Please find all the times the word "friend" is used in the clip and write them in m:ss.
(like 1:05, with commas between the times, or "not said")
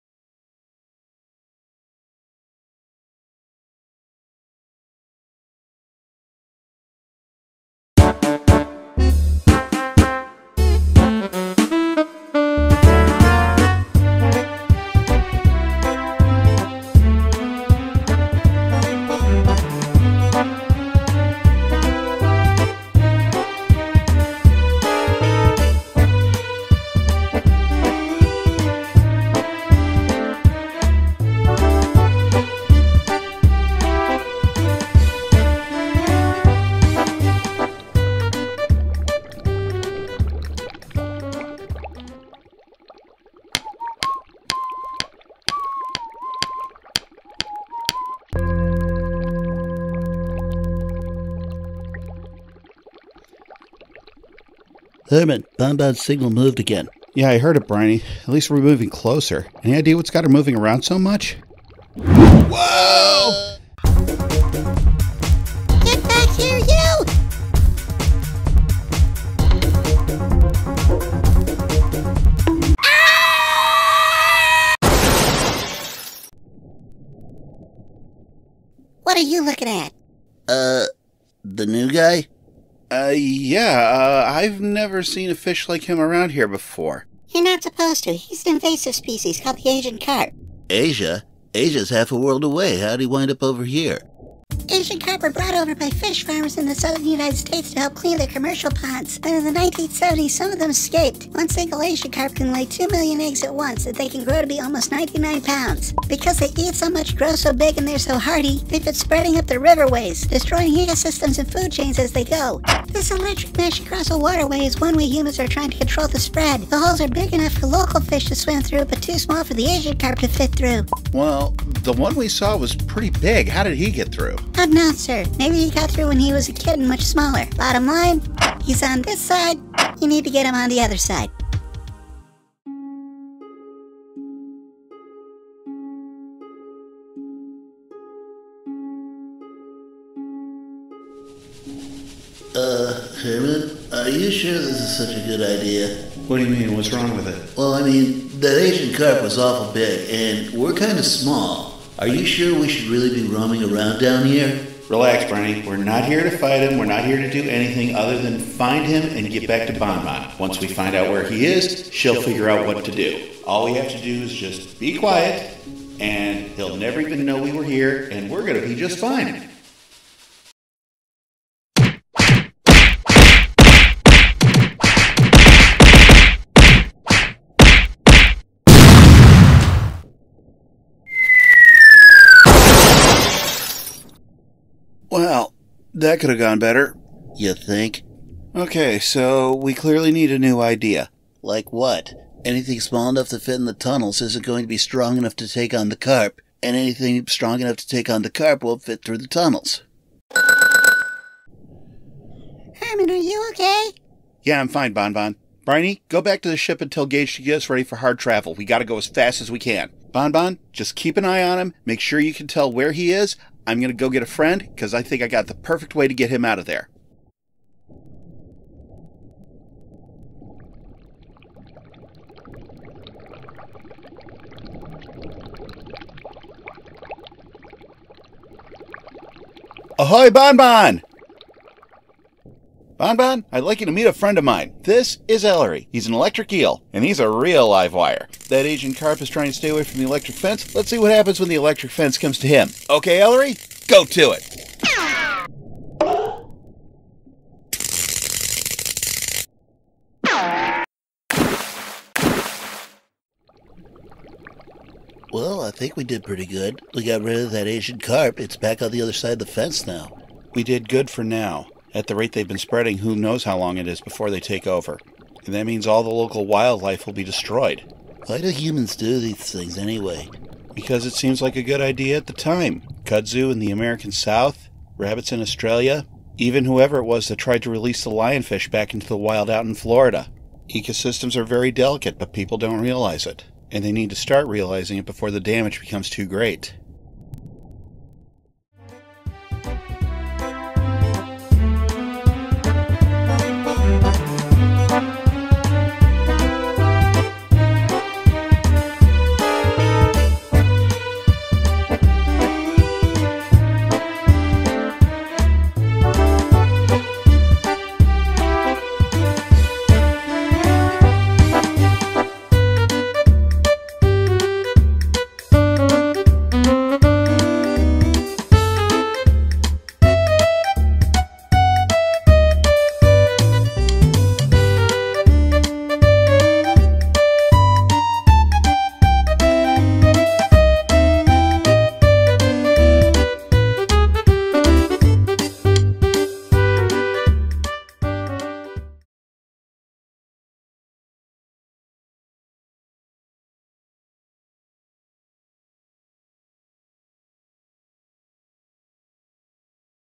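3:34, 3:54.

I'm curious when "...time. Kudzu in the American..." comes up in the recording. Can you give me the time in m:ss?
4:32.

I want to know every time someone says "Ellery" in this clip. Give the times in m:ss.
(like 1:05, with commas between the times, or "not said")
3:55, 4:03.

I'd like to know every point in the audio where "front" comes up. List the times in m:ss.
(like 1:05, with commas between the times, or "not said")
not said.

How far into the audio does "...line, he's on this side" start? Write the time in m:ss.
2:07.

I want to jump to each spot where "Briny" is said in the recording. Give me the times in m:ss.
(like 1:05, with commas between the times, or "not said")
0:57, 3:25.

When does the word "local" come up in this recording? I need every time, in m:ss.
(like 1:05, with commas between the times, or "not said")
1:57, 4:26.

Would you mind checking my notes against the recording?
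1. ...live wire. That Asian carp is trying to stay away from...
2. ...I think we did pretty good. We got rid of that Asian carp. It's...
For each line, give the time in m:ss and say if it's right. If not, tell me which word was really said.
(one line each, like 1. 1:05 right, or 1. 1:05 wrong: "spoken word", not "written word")
1. 3:57 right
2. 4:15 right.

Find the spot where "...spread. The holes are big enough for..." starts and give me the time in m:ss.
1:56.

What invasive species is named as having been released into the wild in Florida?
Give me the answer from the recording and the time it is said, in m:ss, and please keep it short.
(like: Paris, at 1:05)
lionfish, at 4:38.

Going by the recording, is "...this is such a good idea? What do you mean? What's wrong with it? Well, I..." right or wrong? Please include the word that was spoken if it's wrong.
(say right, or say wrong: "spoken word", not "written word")
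right.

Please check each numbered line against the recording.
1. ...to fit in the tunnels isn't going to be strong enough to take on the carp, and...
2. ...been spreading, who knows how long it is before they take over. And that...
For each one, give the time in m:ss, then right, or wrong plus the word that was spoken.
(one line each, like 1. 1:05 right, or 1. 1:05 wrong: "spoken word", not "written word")
1. 3:13 right
2. 4:22 right.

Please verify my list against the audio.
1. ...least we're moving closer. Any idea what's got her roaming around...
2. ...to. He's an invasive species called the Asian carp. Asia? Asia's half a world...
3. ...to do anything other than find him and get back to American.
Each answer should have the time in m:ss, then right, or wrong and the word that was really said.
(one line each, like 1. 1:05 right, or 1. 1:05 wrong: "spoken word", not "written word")
1. 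0:58 wrong: "moving", not "roaming"
2. 1:28 right
3. 2:37 wrong: "Bonmont", not "American".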